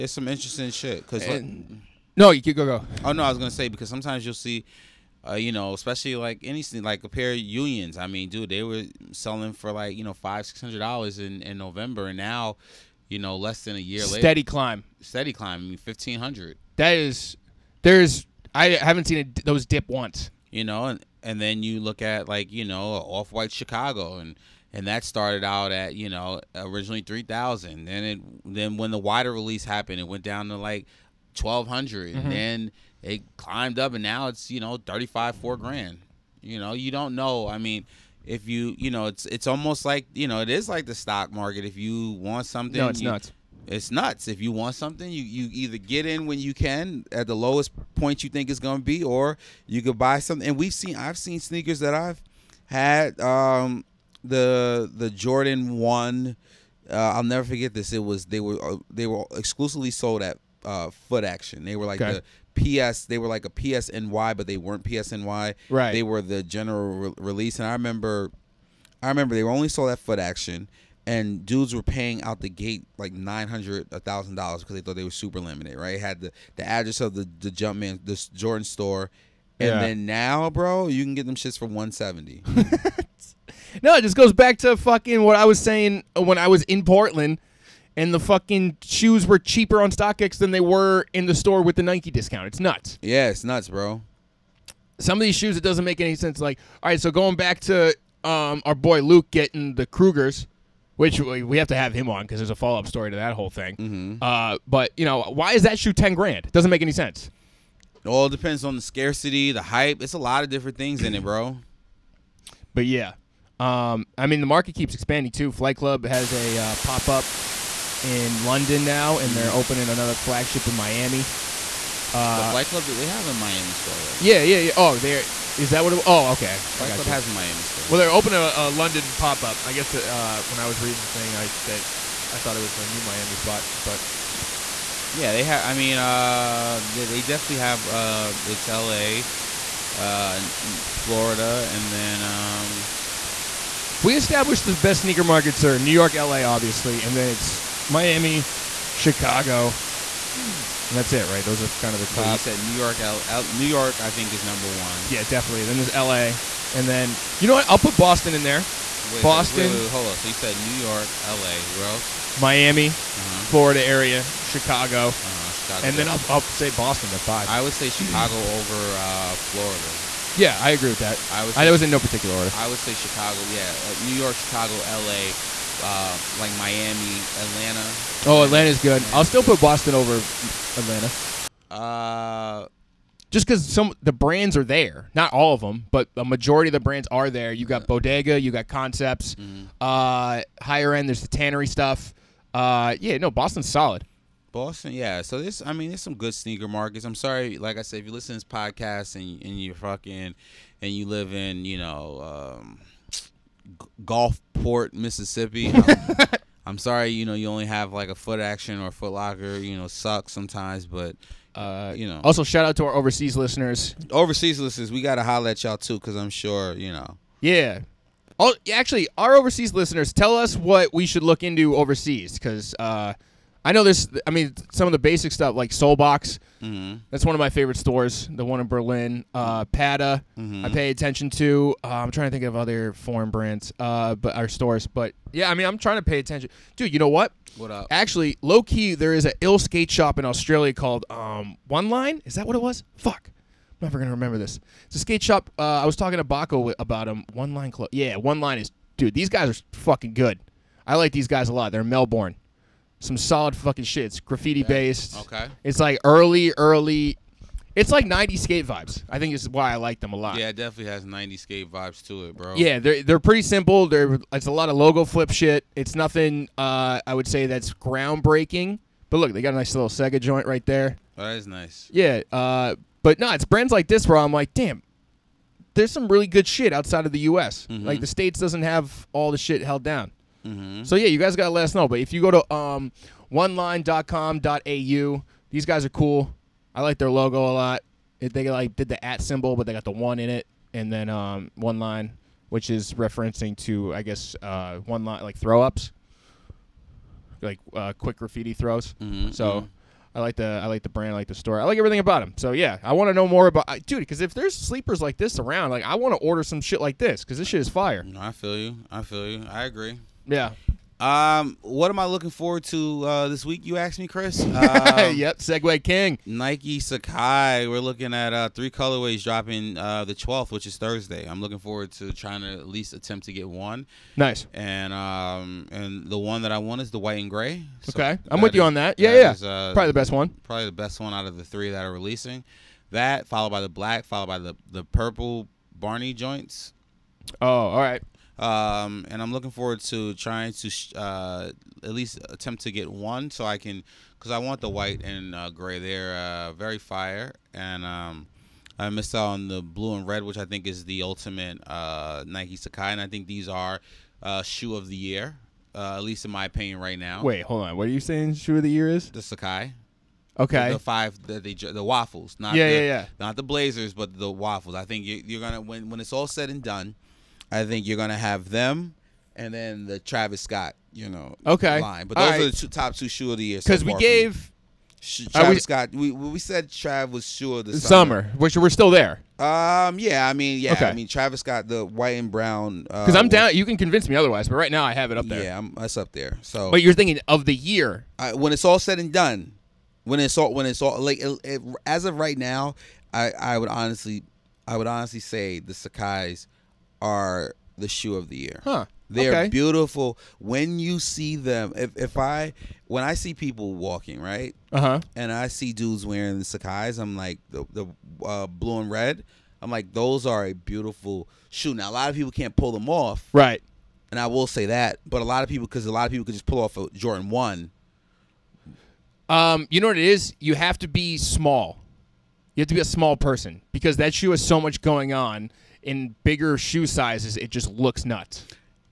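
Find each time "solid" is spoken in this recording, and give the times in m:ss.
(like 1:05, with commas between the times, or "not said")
3:13, 4:13.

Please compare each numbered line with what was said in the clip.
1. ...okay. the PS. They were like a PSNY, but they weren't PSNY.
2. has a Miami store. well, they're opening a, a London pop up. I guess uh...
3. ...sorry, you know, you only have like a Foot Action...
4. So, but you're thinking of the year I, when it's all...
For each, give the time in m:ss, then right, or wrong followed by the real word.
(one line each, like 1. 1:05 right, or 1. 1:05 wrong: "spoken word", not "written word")
1. 1:02 right
2. 2:07 right
3. 3:26 right
4. 6:26 right.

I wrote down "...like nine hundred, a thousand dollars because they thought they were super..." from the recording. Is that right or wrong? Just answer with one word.
right.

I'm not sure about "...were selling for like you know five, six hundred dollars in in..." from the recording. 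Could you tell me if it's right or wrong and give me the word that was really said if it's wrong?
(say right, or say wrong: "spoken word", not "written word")
right.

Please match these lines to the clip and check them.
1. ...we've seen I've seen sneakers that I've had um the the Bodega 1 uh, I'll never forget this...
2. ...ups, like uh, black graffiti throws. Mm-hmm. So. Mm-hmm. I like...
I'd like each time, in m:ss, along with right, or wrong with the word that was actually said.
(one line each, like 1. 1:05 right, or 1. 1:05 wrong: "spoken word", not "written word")
1. 0:50 wrong: "Jordan", not "Bodega"
2. 4:55 wrong: "quick", not "black".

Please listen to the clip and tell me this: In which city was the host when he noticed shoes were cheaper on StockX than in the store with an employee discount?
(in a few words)
Portland.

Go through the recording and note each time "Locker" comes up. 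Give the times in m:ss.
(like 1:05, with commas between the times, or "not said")
3:29.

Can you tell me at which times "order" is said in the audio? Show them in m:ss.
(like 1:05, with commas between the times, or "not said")
2:52, 5:06.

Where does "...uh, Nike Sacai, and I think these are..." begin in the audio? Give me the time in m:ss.
5:51.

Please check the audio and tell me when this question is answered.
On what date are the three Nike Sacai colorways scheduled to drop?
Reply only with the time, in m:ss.
5:20.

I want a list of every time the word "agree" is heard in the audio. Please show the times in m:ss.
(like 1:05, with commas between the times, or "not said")
2:50, 5:09.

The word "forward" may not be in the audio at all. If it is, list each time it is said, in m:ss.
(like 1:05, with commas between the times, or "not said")
5:12, 5:21, 5:39.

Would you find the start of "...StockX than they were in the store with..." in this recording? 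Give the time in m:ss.
1:29.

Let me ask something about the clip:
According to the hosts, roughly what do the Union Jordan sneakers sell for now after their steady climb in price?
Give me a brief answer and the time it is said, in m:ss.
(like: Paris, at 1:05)
1500, at 0:15.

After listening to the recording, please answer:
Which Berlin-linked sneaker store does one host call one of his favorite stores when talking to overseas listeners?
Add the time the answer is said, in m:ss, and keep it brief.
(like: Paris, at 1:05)
Solebox, at 3:45.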